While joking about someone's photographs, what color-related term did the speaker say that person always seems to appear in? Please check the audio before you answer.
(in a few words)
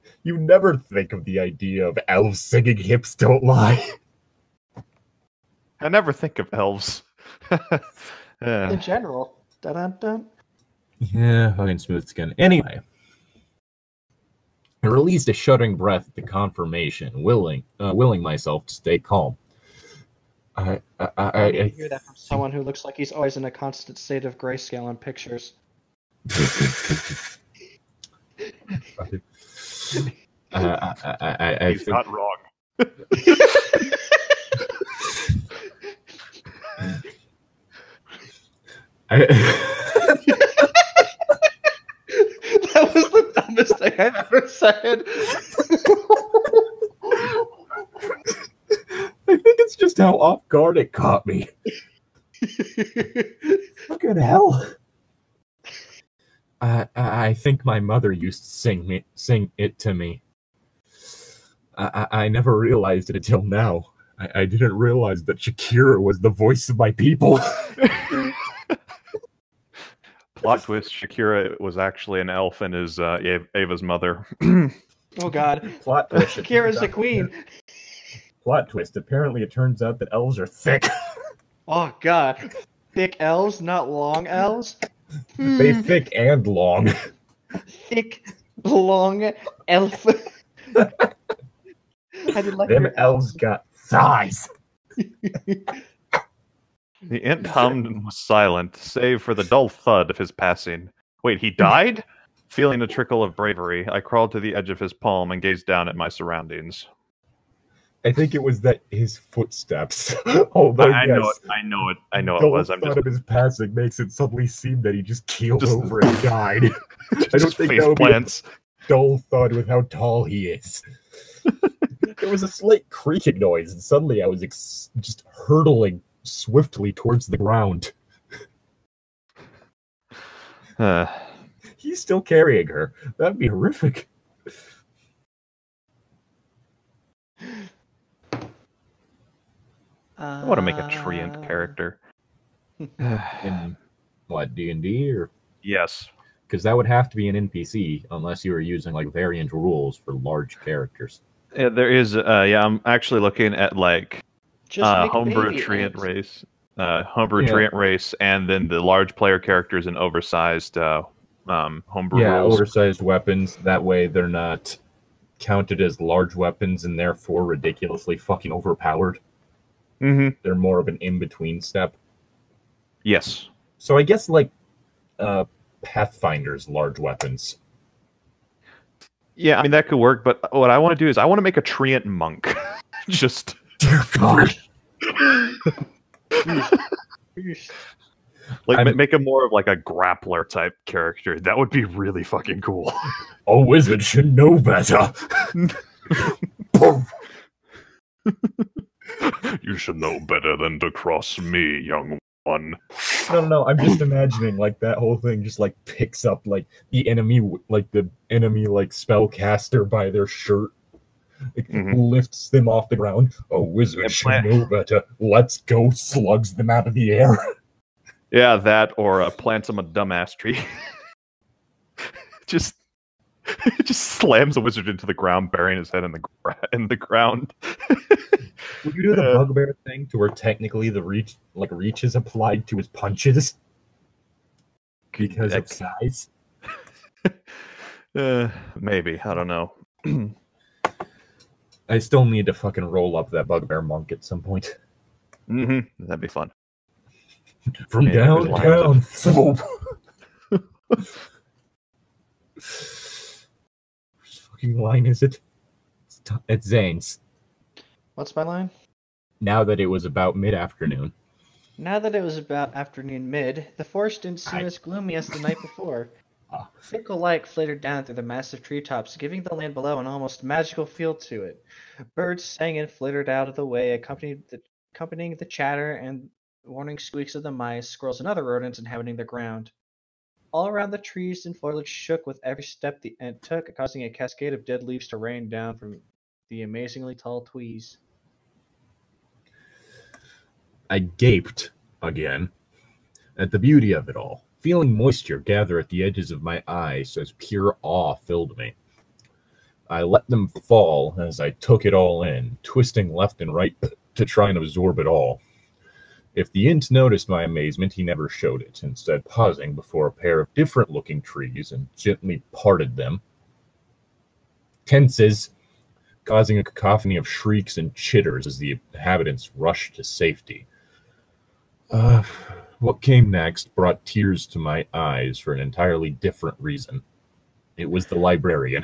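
grayscale.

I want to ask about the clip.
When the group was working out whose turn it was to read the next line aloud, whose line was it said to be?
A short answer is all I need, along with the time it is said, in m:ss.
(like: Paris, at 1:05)
Zane's, at 4:16.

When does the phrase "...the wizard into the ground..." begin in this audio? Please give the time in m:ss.
3:44.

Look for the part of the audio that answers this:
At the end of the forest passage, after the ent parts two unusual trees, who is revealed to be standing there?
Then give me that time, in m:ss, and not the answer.
5:28.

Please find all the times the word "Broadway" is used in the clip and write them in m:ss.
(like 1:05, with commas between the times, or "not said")
not said.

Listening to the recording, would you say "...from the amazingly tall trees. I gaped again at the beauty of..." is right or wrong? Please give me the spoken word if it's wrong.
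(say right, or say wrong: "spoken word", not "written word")
right.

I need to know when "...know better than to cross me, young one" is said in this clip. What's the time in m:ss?
3:19.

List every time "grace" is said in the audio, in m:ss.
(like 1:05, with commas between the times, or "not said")
not said.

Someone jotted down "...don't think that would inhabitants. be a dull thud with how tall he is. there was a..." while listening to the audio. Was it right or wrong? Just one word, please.
wrong.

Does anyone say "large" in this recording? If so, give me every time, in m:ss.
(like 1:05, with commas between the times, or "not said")
2:30, 2:38, 2:45, 2:56.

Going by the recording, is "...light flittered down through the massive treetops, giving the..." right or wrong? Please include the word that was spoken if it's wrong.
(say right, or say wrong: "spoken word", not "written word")
right.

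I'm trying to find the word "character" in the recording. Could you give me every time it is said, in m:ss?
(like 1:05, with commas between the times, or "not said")
2:21, 2:30, 2:39, 3:10.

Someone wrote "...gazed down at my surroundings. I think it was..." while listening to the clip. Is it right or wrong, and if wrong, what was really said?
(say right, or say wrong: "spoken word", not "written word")
right.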